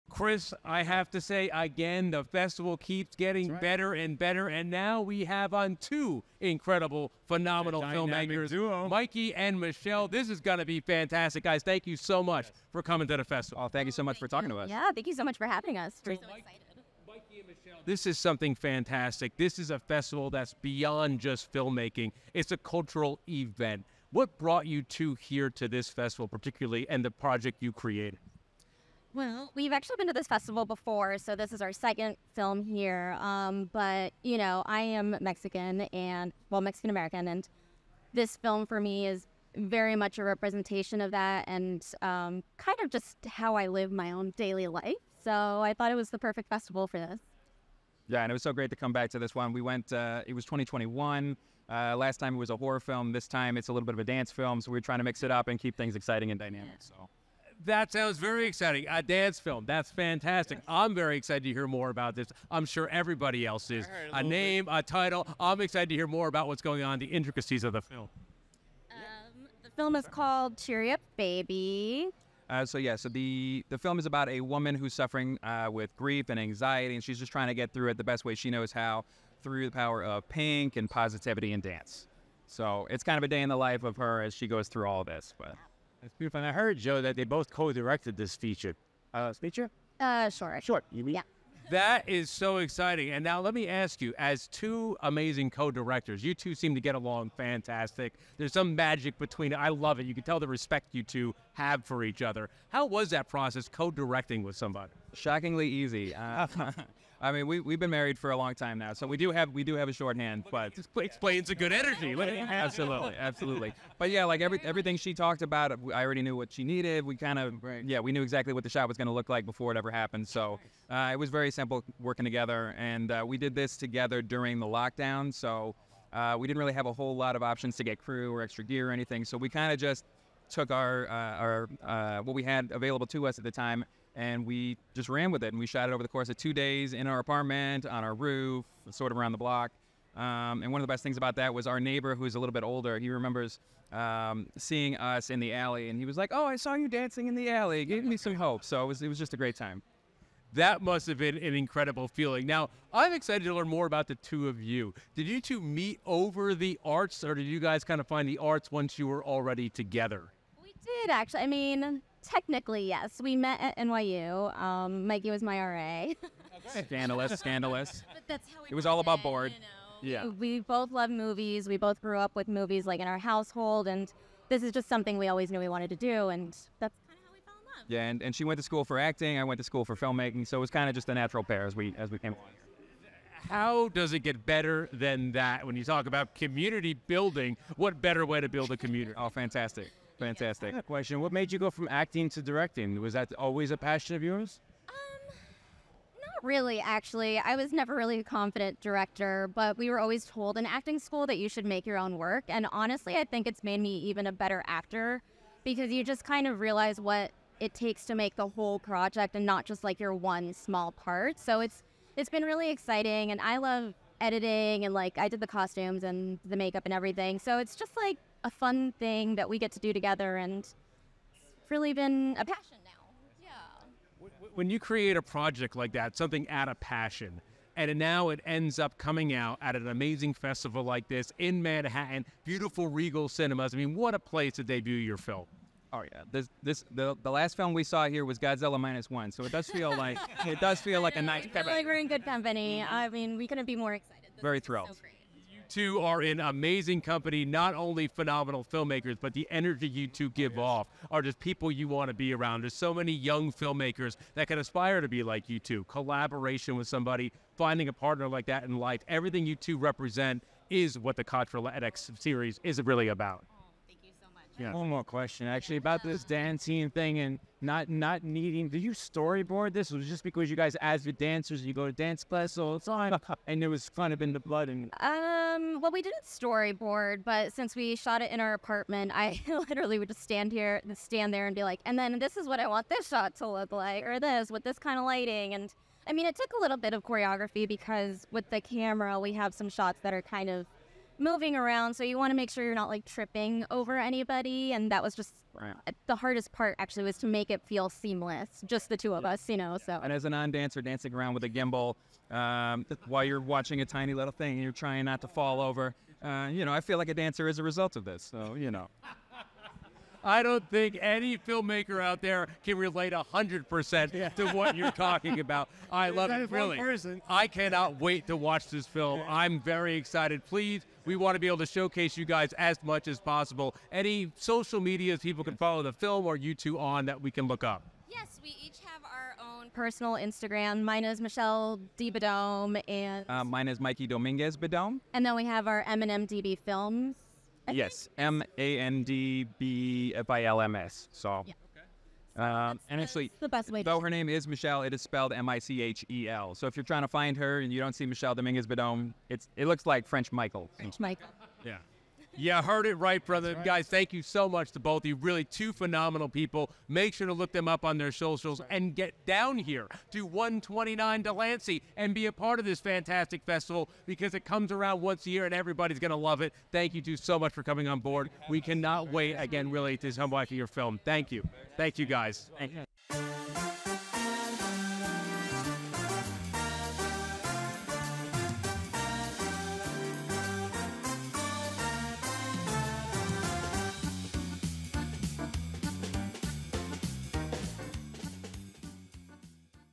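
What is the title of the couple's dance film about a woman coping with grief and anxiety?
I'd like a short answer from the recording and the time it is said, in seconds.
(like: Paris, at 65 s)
Cheery Up Baby, at 70 s.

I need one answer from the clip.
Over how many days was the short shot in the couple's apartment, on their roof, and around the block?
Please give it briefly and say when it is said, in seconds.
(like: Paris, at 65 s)
2, at 136 s.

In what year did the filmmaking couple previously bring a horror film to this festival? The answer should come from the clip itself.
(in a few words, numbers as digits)
2021.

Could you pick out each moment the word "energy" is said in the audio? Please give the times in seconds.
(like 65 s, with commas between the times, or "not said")
111 s, 249 s.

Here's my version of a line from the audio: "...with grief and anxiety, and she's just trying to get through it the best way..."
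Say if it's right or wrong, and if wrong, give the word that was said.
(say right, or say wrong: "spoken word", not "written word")
right.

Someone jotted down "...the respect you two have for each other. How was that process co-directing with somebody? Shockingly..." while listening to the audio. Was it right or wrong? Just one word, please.
right.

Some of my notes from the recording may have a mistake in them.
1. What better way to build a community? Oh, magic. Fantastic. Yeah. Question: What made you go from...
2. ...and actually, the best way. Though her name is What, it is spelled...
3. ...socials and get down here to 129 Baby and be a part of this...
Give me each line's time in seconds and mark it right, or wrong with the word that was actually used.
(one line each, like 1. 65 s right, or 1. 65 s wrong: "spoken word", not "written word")
1. 187 s wrong: "fantastic", not "magic"
2. 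342 s wrong: "Michelle", not "What"
3. 358 s wrong: "Delancey", not "Baby".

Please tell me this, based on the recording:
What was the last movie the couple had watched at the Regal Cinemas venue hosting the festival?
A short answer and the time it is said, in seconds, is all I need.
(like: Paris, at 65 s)
Godzilla Minus One, at 238 s.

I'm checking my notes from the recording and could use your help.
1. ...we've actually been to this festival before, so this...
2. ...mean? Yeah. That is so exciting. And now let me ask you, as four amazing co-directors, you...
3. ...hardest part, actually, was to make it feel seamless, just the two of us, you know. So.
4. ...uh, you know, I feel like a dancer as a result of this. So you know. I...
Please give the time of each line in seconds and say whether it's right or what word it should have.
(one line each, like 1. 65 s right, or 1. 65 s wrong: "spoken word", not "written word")
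1. 29 s right
2. 91 s wrong: "two", not "four"
3. 296 s right
4. 306 s right.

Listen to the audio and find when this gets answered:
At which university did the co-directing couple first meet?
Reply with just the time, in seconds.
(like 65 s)
163 s.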